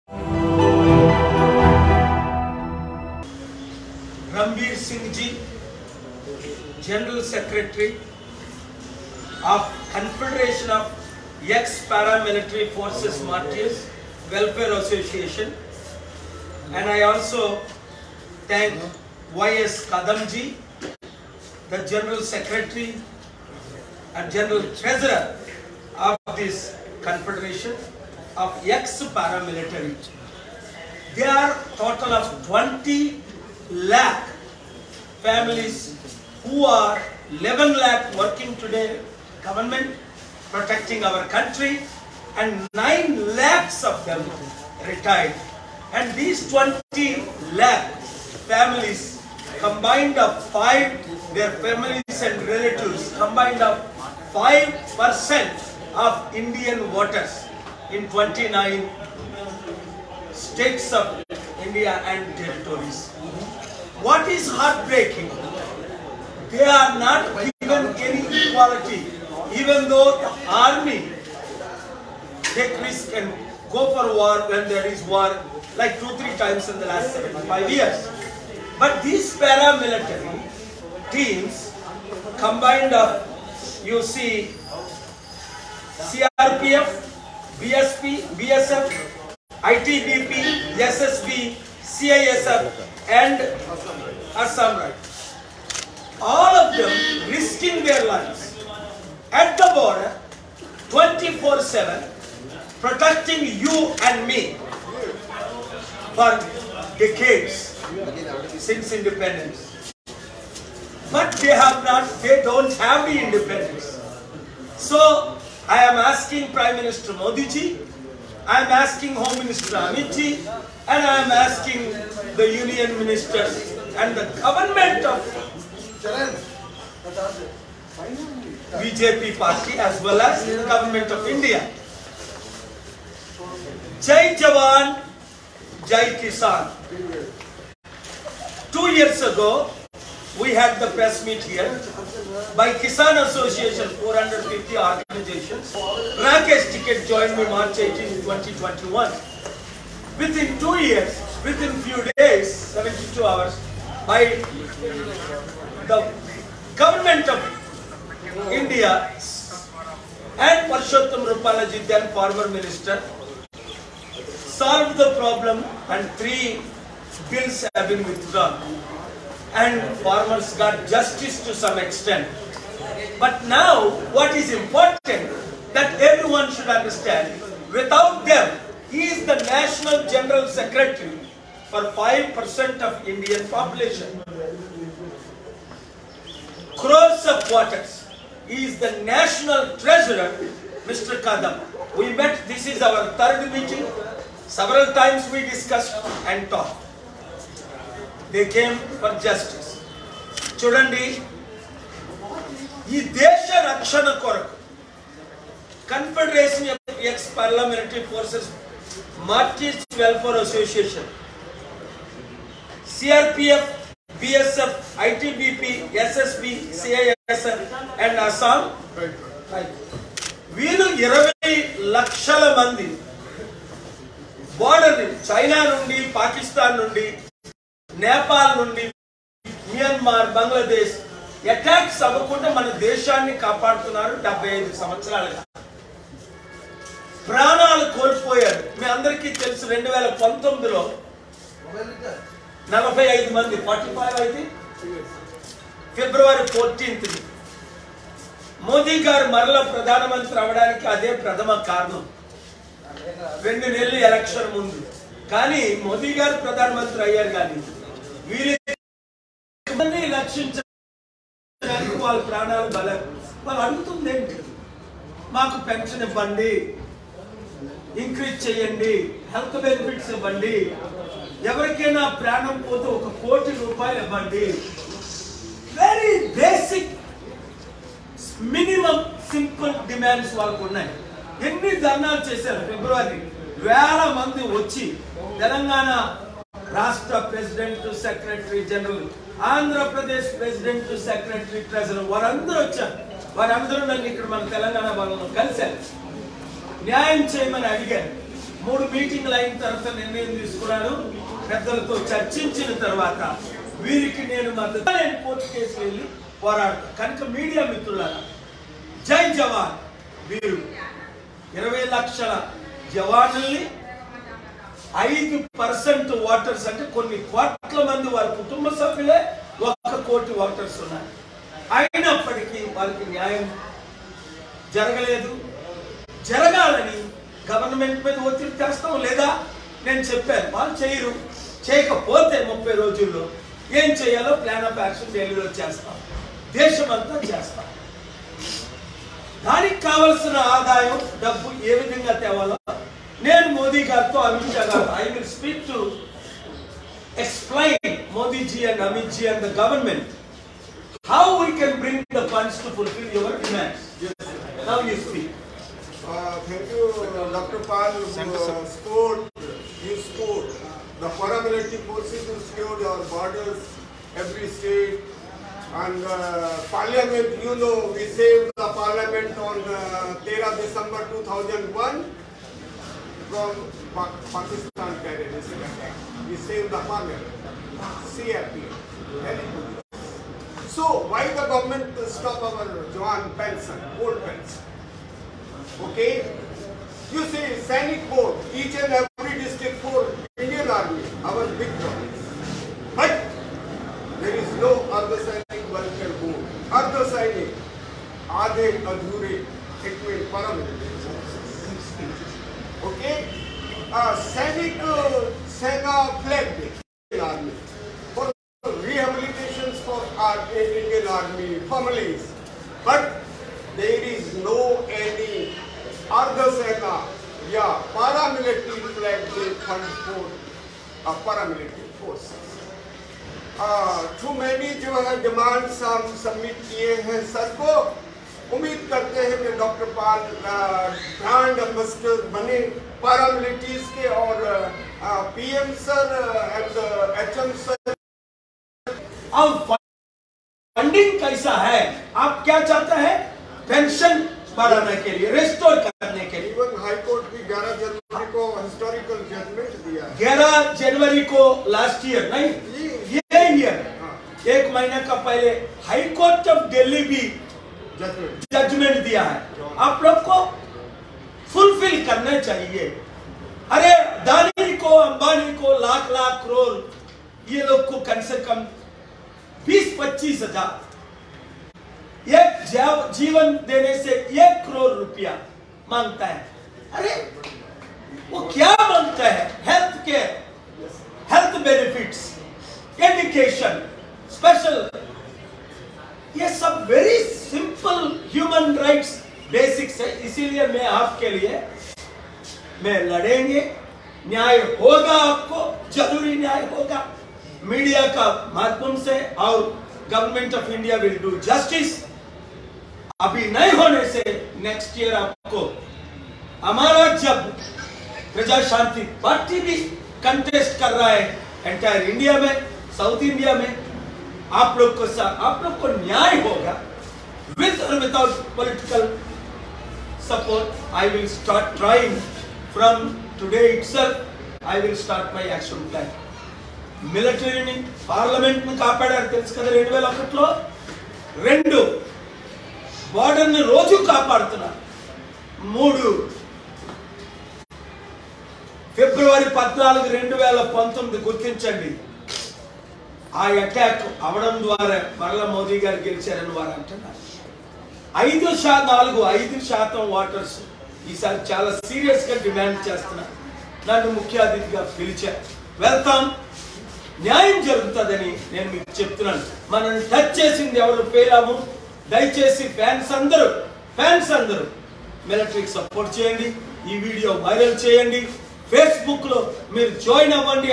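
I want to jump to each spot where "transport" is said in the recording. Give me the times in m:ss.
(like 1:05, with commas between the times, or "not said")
6:59.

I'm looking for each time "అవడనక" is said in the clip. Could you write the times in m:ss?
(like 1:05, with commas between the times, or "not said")
4:10.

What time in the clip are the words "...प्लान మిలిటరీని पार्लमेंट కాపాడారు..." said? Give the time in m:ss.
8:45.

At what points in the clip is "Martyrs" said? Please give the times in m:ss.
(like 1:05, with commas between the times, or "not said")
0:13, 3:29.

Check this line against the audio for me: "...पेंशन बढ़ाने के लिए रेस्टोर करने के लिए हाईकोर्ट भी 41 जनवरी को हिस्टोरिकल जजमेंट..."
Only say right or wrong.
wrong.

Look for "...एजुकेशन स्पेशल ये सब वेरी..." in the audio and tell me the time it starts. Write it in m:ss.
8:03.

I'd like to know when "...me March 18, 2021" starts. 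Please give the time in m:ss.
2:27.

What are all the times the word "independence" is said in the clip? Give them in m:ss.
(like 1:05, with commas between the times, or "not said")
1:48, 1:53.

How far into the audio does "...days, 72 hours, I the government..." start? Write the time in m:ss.
2:32.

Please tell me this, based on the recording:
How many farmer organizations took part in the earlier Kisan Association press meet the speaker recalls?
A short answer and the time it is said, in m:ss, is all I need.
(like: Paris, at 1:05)
450, at 2:24.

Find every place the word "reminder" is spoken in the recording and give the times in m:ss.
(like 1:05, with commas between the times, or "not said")
not said.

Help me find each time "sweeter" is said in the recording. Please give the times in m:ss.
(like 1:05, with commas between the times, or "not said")
not said.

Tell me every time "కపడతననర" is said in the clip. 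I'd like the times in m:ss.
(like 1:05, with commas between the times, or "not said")
3:53, 8:54.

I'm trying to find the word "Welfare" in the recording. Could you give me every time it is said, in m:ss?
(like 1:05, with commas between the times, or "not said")
0:14, 3:30.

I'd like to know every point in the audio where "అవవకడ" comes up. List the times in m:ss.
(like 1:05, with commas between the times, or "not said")
3:52.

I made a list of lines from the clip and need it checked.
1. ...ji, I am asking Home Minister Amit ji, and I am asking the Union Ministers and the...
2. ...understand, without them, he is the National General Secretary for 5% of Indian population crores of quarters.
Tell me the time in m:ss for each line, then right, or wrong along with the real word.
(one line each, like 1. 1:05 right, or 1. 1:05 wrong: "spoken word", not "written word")
1. 1:57 right
2. 2:56 right.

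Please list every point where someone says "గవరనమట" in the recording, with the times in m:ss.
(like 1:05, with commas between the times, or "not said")
5:27, 5:49.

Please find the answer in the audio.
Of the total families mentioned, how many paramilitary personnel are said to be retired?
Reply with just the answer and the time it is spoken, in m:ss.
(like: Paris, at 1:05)
9 lakh, at 0:42.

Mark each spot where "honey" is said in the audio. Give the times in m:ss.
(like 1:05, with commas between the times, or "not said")
not said.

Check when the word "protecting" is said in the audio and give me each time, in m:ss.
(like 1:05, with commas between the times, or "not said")
0:40, 1:42.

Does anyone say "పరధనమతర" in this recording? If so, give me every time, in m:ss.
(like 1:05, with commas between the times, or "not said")
4:09, 4:16.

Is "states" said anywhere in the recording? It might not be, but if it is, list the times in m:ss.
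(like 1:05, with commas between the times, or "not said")
1:00, 6:04.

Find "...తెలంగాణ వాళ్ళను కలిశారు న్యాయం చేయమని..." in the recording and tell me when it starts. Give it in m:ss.
4:54.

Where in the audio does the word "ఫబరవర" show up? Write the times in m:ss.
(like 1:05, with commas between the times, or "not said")
4:05, 4:42, 8:58.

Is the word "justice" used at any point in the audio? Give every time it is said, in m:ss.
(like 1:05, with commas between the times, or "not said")
2:50, 3:19.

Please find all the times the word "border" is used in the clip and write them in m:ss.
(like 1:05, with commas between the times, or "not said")
1:39, 6:03.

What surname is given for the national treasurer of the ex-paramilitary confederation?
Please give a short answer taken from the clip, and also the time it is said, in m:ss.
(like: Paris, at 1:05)
Kadam, at 3:10.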